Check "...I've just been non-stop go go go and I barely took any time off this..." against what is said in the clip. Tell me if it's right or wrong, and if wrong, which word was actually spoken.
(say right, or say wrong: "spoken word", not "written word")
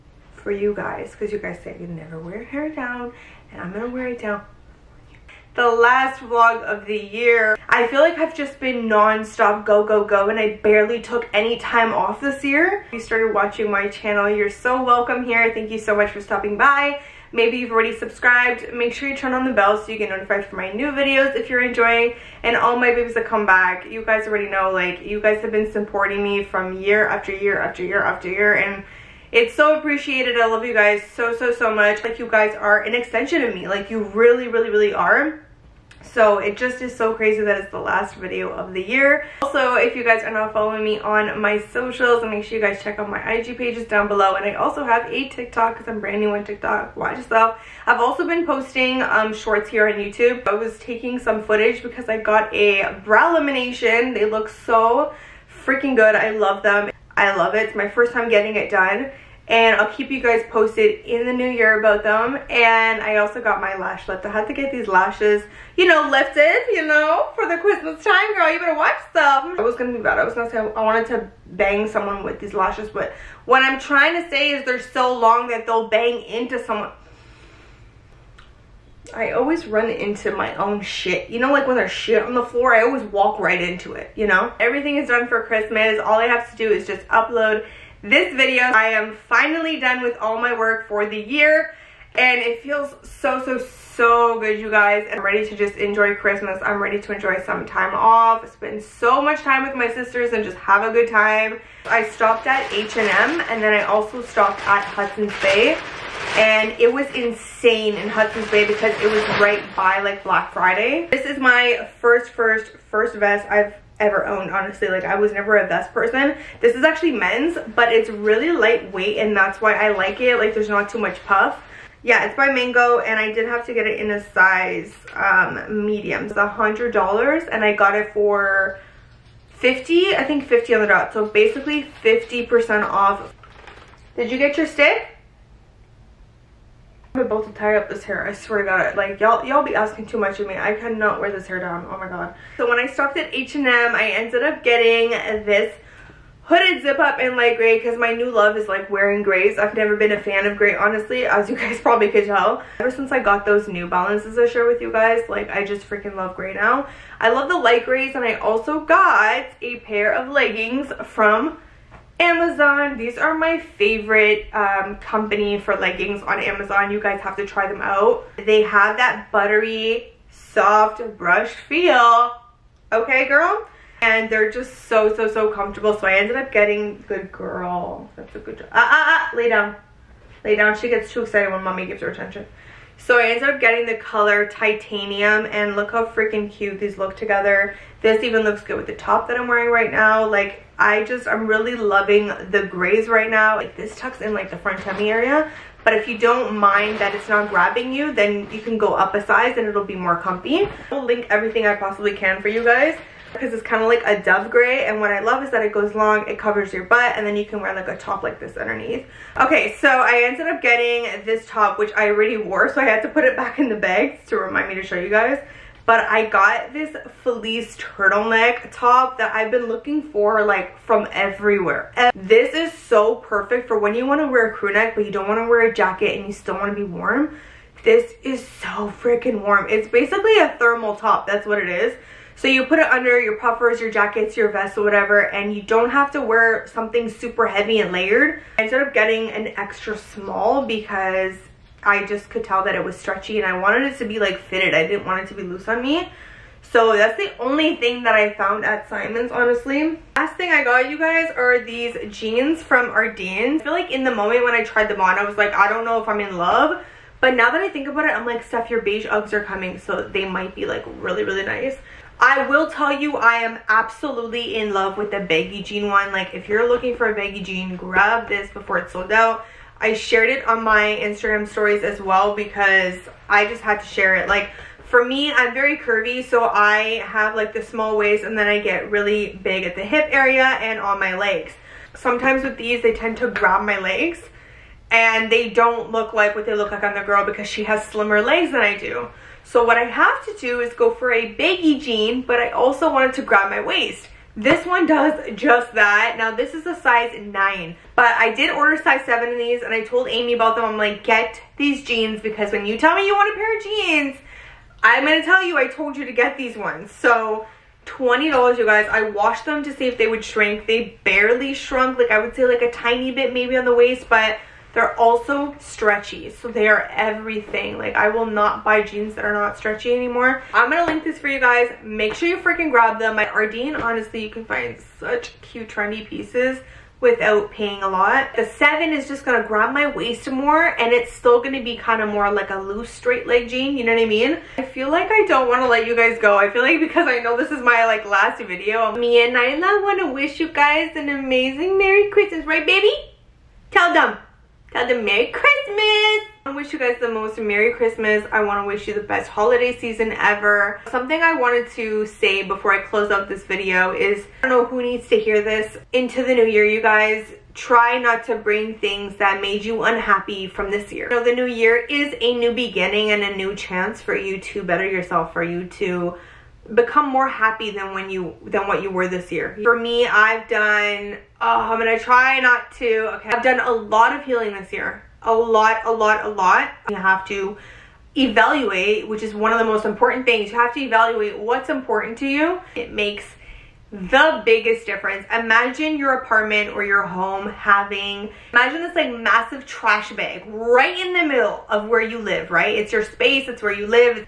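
right.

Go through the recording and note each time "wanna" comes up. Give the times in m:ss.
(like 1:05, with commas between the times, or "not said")
5:35, 5:39.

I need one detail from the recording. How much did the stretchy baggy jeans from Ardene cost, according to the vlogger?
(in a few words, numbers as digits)
$20.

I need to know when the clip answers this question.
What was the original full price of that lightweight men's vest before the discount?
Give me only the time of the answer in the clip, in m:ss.
2:06.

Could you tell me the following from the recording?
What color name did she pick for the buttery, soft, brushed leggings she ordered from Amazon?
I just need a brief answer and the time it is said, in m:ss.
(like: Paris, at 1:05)
Titanium, at 3:04.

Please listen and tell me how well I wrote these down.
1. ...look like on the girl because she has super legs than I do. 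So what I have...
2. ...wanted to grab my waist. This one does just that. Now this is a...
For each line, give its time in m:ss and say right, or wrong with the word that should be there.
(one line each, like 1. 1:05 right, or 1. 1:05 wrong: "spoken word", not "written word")
1. 4:46 wrong: "slimmer", not "super"
2. 4:52 right.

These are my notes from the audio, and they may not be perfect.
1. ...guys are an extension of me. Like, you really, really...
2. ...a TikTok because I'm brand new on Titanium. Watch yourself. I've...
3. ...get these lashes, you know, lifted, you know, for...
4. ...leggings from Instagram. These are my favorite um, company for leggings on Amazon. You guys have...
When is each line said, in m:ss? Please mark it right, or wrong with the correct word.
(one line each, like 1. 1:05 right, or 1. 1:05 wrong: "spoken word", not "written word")
1. 0:32 right
2. 0:45 wrong: "TikTok", not "Titanium"
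3. 1:04 right
4. 2:40 wrong: "Amazon", not "Instagram".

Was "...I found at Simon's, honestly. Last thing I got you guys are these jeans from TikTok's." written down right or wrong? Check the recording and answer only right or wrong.
wrong.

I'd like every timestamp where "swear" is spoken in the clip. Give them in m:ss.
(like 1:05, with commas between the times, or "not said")
2:18.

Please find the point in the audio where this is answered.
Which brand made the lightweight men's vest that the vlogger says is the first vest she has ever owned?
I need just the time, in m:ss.
2:02.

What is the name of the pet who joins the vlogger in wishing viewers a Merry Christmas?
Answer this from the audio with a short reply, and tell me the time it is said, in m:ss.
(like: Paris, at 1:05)
Nyla, at 5:39.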